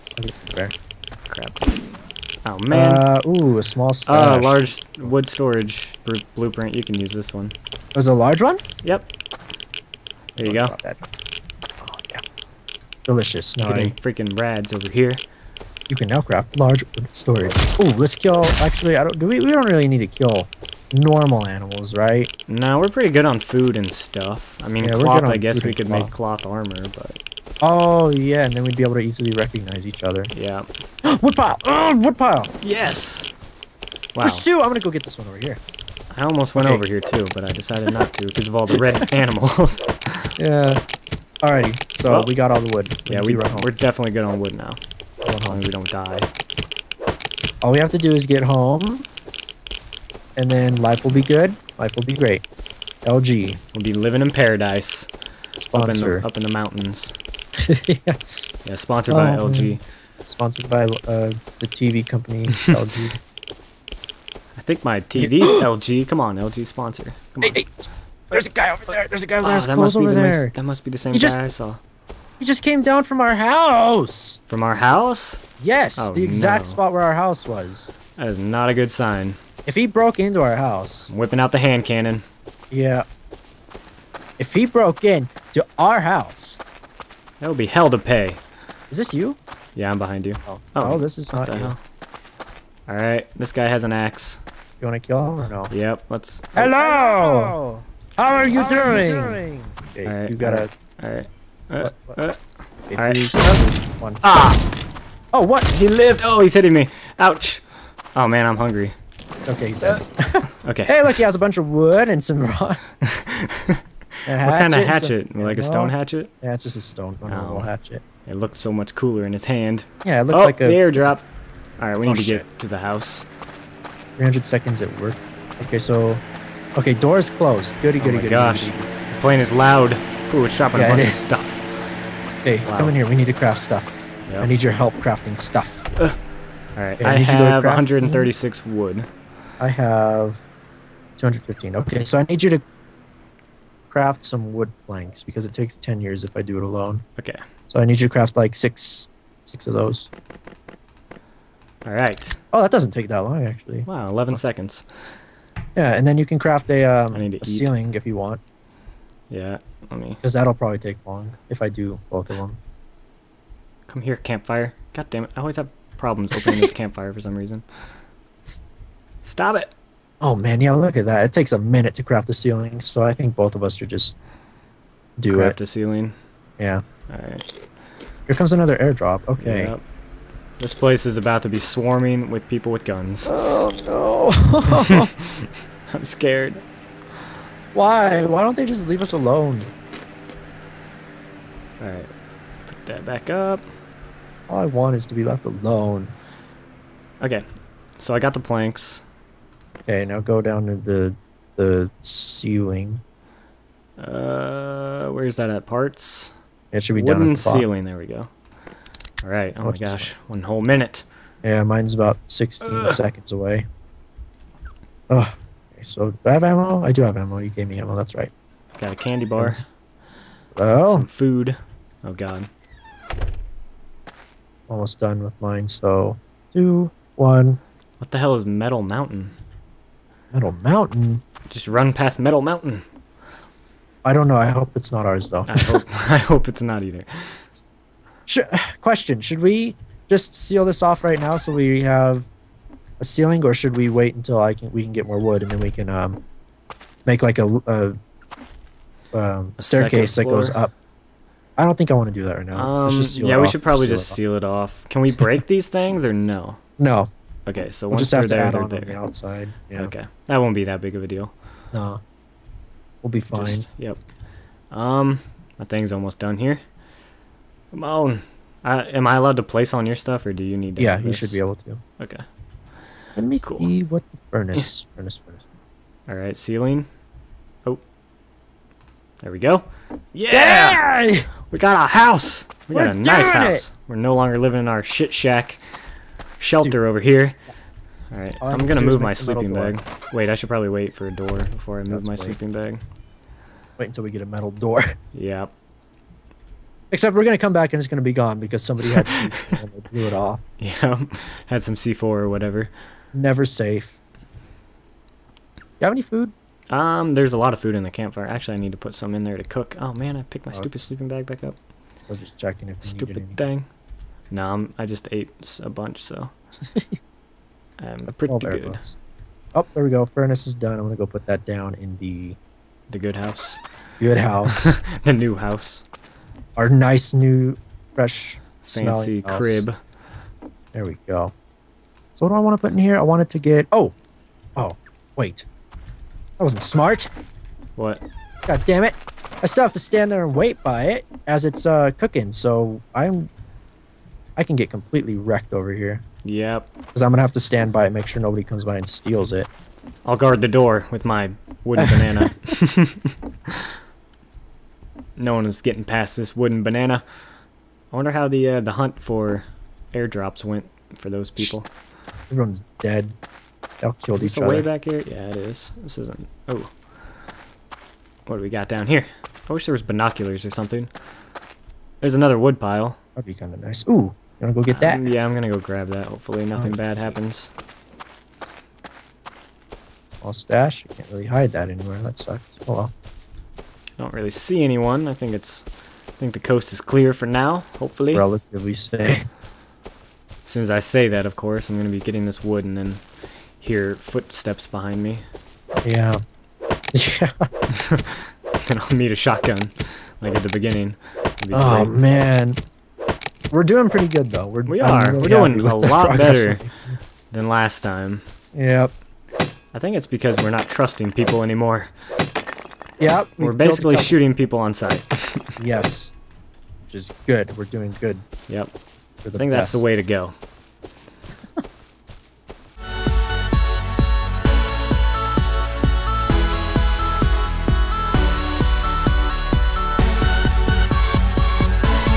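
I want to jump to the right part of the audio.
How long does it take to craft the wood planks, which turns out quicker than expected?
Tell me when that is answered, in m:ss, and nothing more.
2:34.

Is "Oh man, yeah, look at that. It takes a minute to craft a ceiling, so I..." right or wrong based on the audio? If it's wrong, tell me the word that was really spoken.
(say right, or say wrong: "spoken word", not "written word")
right.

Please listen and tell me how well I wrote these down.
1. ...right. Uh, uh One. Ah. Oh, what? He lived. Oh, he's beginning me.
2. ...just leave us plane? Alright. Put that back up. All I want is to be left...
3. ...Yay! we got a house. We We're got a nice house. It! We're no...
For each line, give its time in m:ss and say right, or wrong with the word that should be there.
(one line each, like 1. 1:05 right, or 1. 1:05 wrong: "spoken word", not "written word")
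1. 1:42 wrong: "hitting", not "beginning"
2. 3:08 wrong: "alone", not "plane"
3. 4:41 right.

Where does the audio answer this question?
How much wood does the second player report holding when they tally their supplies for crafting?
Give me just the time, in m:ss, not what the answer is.
2:21.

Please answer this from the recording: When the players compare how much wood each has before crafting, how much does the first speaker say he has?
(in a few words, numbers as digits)
136.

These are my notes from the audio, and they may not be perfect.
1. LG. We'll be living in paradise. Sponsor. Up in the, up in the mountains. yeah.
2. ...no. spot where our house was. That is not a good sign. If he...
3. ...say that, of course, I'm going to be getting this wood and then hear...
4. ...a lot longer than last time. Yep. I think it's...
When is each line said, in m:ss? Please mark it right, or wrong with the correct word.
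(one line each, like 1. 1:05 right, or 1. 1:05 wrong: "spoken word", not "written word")
1. 0:53 right
2. 1:16 right
3. 6:30 right
4. 6:45 wrong: "better", not "longer".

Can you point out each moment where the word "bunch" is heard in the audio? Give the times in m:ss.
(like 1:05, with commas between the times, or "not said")
1:51, 2:10, 5:15.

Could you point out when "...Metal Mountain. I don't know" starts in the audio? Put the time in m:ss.
3:52.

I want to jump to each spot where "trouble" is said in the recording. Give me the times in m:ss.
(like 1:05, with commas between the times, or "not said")
not said.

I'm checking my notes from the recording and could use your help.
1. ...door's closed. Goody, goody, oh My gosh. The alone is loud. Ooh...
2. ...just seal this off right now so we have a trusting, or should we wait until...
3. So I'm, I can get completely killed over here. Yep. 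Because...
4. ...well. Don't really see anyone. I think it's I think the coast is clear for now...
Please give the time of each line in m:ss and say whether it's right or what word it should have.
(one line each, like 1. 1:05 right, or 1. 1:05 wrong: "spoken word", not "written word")
1. 2:06 wrong: "plane", not "alone"
2. 4:00 wrong: "ceiling", not "trusting"
3. 5:42 wrong: "wrecked", not "killed"
4. 6:22 right.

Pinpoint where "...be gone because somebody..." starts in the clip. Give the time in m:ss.
4:58.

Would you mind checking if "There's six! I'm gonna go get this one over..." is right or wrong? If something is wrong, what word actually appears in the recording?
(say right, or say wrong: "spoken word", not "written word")
wrong: "two", not "six".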